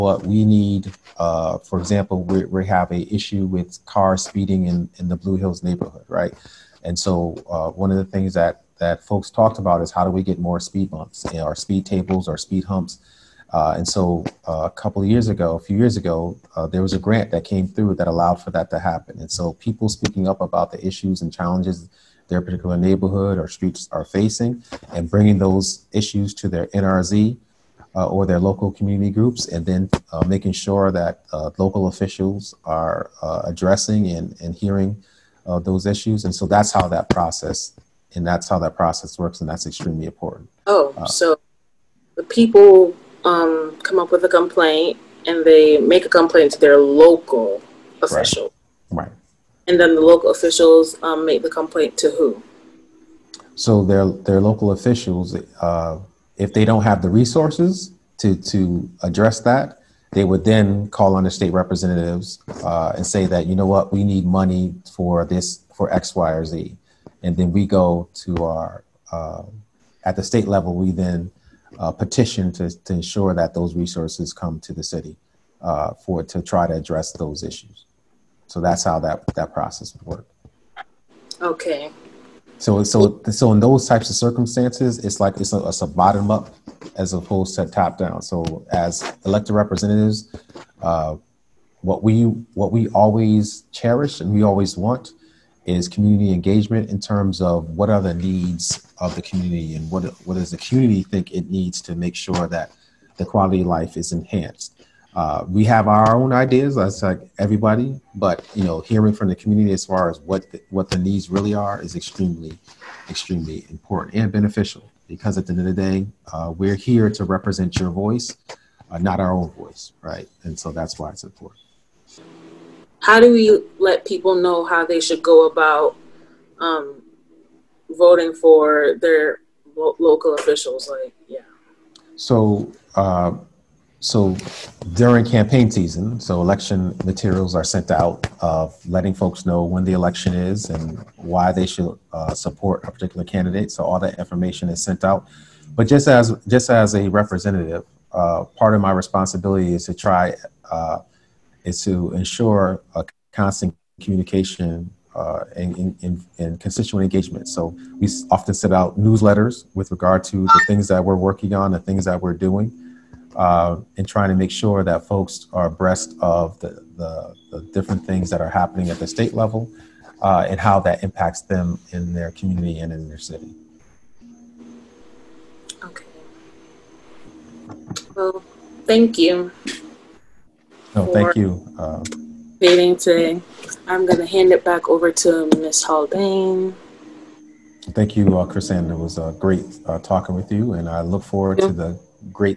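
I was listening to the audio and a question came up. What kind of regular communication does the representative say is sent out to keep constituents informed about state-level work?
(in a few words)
newsletters.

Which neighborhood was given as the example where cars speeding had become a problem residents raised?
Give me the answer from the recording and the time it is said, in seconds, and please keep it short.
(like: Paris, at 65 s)
Blue Hills, at 5 s.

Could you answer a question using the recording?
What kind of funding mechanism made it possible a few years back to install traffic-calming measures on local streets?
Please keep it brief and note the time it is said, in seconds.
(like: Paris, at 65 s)
a grant, at 16 s.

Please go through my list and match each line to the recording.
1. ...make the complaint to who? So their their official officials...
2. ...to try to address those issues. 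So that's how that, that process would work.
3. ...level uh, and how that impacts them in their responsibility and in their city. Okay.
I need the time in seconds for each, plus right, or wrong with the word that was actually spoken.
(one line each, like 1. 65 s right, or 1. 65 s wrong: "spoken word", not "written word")
1. 51 s wrong: "local", not "official"
2. 76 s right
3. 169 s wrong: "community", not "responsibility".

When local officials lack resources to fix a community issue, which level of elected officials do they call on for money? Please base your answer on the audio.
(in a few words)
state representatives.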